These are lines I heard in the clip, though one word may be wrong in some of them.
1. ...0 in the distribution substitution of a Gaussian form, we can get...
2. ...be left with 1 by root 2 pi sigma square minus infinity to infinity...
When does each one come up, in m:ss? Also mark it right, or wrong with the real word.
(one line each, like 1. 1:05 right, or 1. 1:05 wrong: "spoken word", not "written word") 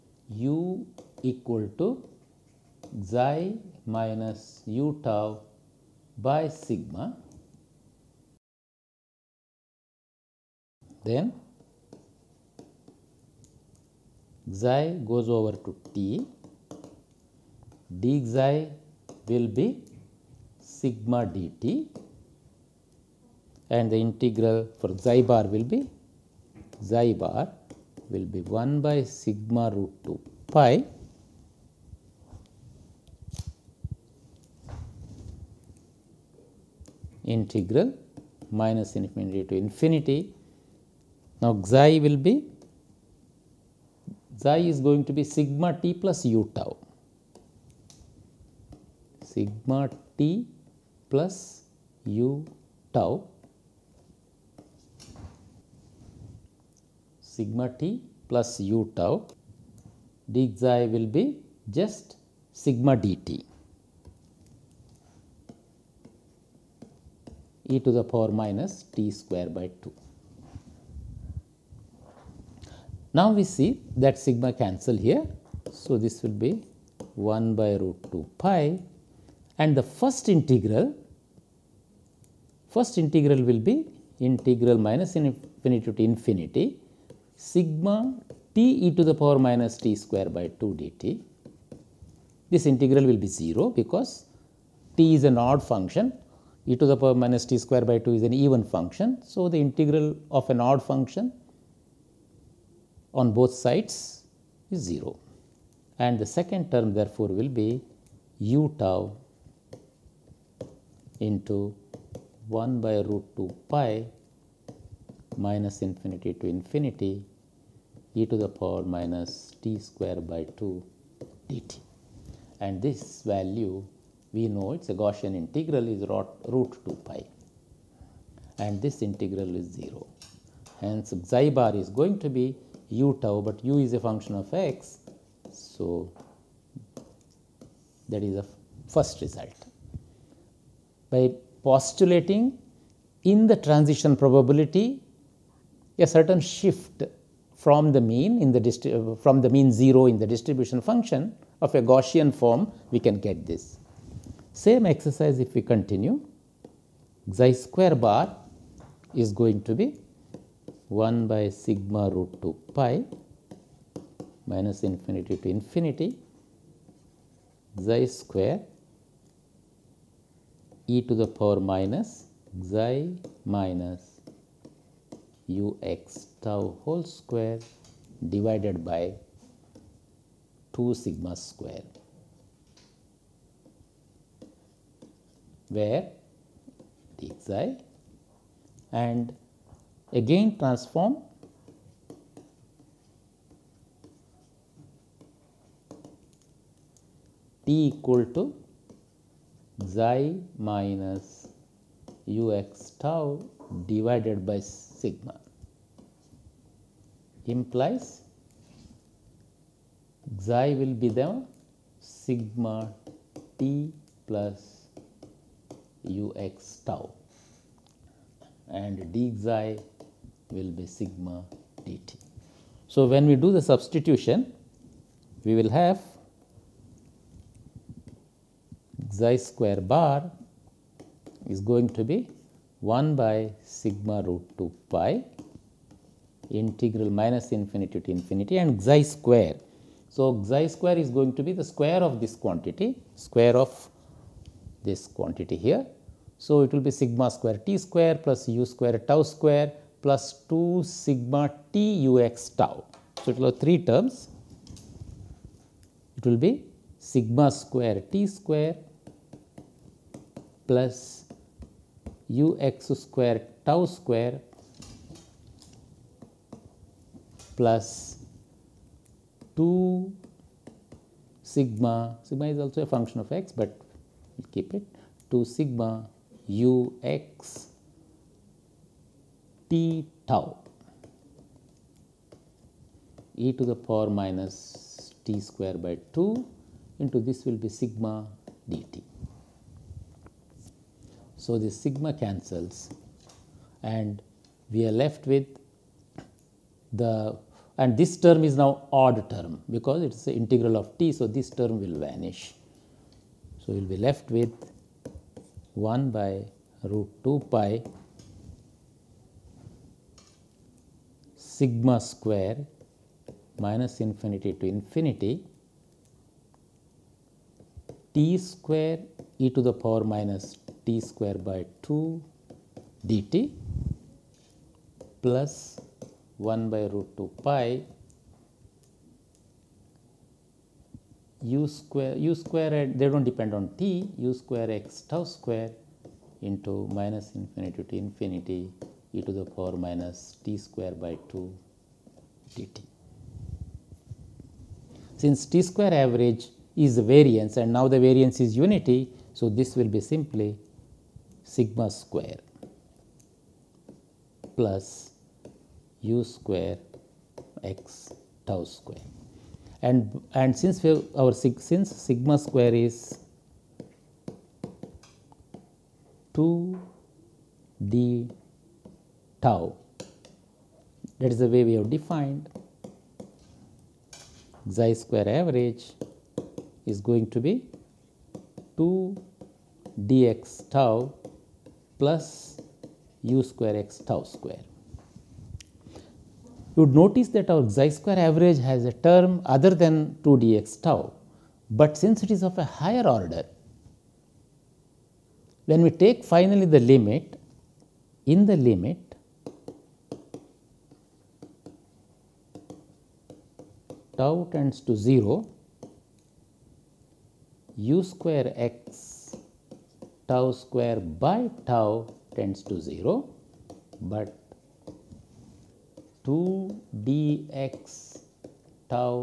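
1. 2:29 wrong: "function", not "substitution"
2. 5:03 right.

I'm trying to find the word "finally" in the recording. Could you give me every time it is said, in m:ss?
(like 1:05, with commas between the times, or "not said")
6:36.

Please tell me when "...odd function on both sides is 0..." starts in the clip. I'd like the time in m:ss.
1:40.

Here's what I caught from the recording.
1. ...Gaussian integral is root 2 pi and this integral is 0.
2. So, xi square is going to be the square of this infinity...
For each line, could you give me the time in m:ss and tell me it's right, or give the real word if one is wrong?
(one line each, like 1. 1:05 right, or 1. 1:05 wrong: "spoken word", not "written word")
1. 2:05 right
2. 4:00 wrong: "quantity", not "infinity".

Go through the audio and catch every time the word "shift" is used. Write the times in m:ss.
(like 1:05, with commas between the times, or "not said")
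2:26.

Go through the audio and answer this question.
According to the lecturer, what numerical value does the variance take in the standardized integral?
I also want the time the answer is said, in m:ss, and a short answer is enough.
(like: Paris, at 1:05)
unity, at 5:48.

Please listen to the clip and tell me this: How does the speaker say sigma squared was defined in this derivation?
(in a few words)
2 d tau.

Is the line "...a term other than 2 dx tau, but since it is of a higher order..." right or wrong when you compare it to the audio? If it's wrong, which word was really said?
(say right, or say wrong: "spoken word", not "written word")
right.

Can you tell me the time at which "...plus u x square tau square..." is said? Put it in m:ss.
4:20.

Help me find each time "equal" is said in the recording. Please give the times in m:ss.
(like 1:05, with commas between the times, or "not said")
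0:01, 3:17.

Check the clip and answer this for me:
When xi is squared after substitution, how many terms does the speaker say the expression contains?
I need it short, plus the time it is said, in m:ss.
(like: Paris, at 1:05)
3, at 4:13.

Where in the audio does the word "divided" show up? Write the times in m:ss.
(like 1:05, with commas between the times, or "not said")
2:58, 3:23.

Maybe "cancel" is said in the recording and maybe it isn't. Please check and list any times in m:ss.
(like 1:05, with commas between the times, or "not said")
1:14, 4:52.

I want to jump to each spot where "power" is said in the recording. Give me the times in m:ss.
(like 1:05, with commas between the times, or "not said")
1:08, 1:29, 1:37, 1:58, 2:51, 4:43, 5:19, 5:39.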